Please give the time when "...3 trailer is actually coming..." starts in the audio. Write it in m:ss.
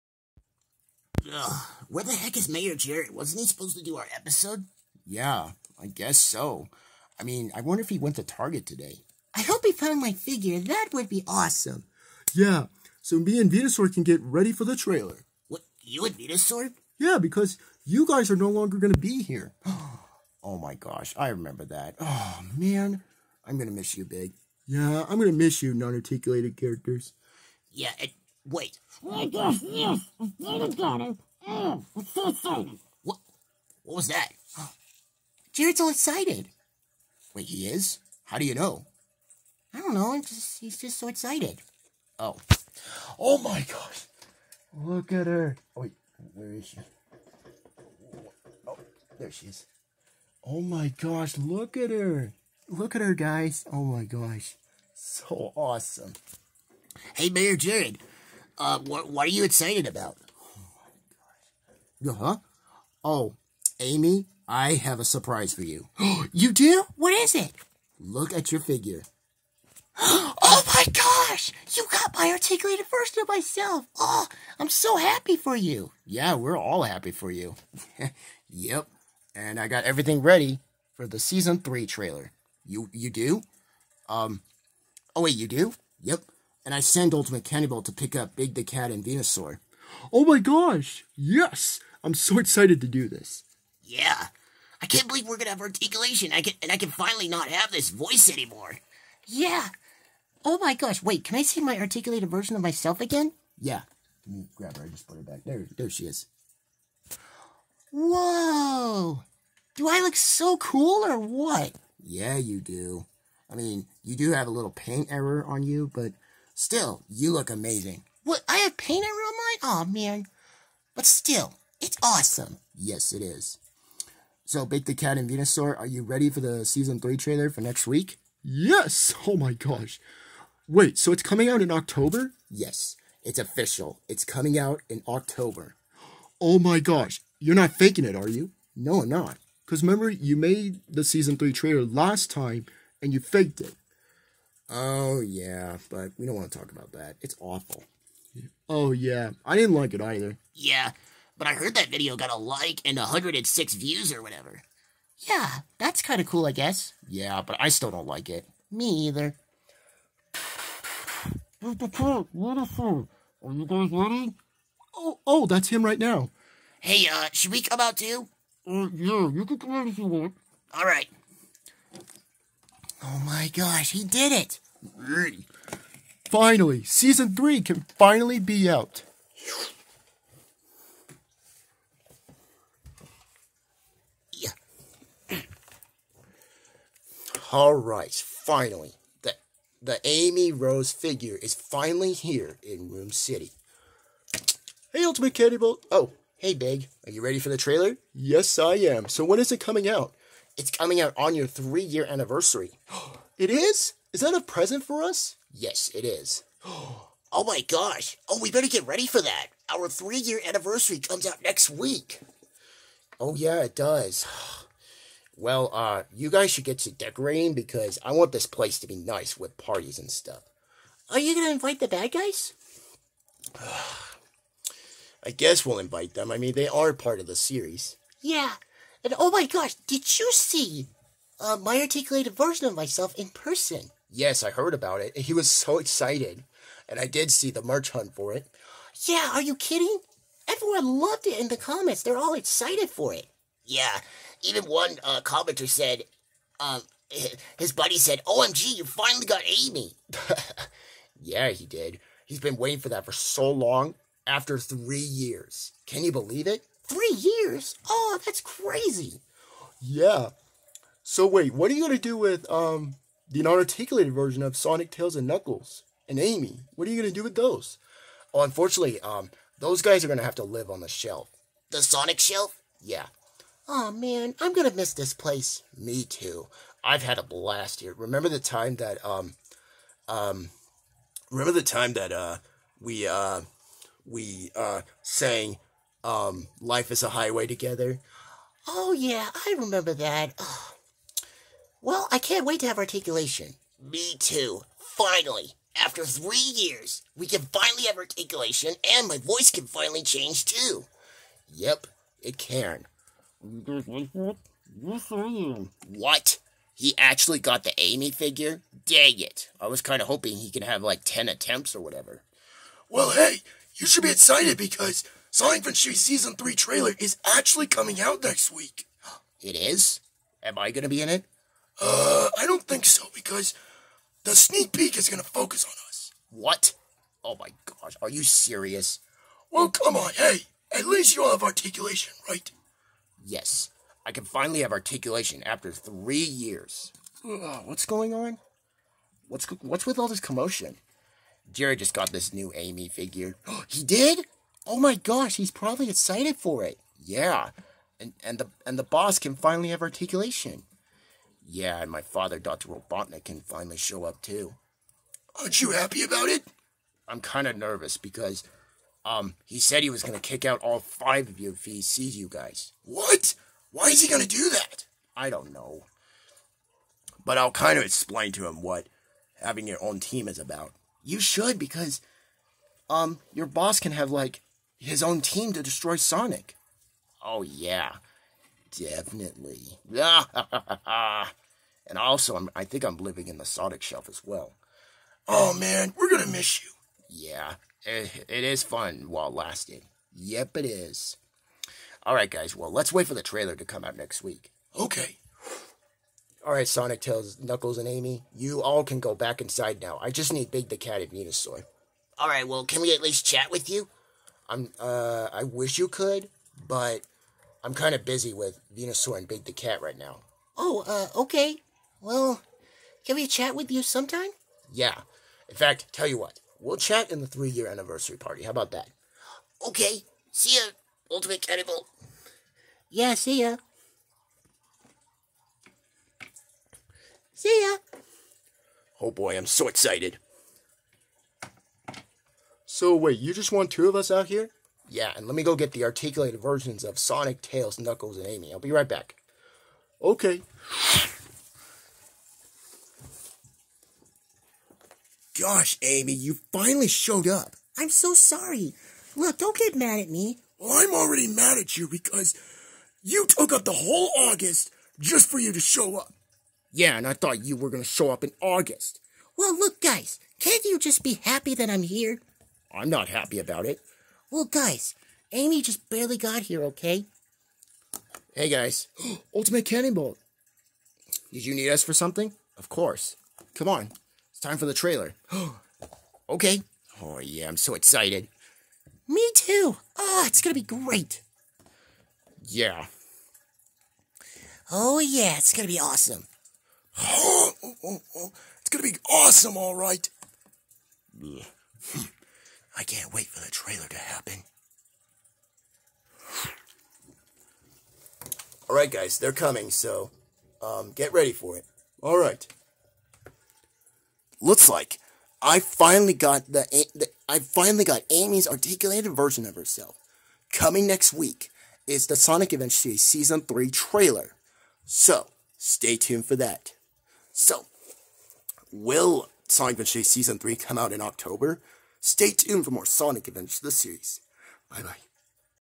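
5:16.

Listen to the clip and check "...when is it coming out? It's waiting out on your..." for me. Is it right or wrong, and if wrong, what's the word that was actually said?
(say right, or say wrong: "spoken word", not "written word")
wrong: "coming", not "waiting".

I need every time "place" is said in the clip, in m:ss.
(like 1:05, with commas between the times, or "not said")
3:38, 4:35.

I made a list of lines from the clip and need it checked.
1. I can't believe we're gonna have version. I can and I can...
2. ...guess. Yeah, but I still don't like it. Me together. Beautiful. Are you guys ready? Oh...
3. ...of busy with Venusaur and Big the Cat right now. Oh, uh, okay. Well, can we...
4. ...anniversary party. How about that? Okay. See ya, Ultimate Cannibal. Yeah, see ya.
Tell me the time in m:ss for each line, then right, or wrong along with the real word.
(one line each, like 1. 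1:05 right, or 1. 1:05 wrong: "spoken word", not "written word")
1. 1:34 wrong: "articulation", not "version"
2. 2:36 wrong: "either", not "together"
3. 6:47 right
4. 6:57 right.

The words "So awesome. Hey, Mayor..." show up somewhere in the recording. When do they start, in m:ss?
0:54.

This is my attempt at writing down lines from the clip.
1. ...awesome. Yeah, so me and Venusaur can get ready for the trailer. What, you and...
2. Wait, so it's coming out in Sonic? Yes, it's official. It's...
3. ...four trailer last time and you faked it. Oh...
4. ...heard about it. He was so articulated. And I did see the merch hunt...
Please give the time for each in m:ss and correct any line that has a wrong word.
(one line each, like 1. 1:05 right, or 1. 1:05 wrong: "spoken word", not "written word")
1. 0:11 right
2. 2:10 wrong: "October", not "Sonic"
3. 2:21 wrong: "three", not "four"
4. 3:54 wrong: "excited", not "articulated".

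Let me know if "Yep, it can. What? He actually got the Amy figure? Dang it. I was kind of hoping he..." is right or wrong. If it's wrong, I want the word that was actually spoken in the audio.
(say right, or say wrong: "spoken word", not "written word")
right.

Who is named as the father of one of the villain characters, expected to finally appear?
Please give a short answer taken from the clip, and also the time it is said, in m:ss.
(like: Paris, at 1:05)
Dr. Robotnik, at 5:52.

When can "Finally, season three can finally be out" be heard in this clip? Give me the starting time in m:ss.
2:56.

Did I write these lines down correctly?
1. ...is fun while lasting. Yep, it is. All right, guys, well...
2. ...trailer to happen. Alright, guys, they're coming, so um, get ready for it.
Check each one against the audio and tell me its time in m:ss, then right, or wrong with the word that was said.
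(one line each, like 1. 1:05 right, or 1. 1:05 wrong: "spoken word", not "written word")
1. 6:28 right
2. 8:13 right.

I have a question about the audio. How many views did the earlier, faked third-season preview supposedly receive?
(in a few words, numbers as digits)
106.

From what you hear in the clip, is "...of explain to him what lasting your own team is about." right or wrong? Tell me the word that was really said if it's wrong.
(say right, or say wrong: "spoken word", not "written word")
wrong: "having", not "lasting".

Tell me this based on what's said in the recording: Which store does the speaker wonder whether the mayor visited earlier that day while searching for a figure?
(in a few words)
Target.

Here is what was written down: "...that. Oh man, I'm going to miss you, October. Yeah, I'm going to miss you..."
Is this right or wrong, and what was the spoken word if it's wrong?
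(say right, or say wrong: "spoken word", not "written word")
wrong: "Big", not "October".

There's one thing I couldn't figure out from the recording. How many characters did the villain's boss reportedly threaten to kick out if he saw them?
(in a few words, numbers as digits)
5.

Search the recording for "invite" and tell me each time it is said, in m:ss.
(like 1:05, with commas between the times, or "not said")
3:41, 3:45.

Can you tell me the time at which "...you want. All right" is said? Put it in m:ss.
2:49.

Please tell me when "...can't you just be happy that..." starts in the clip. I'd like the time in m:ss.
7:40.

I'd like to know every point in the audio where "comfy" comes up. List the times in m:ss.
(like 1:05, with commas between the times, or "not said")
not said.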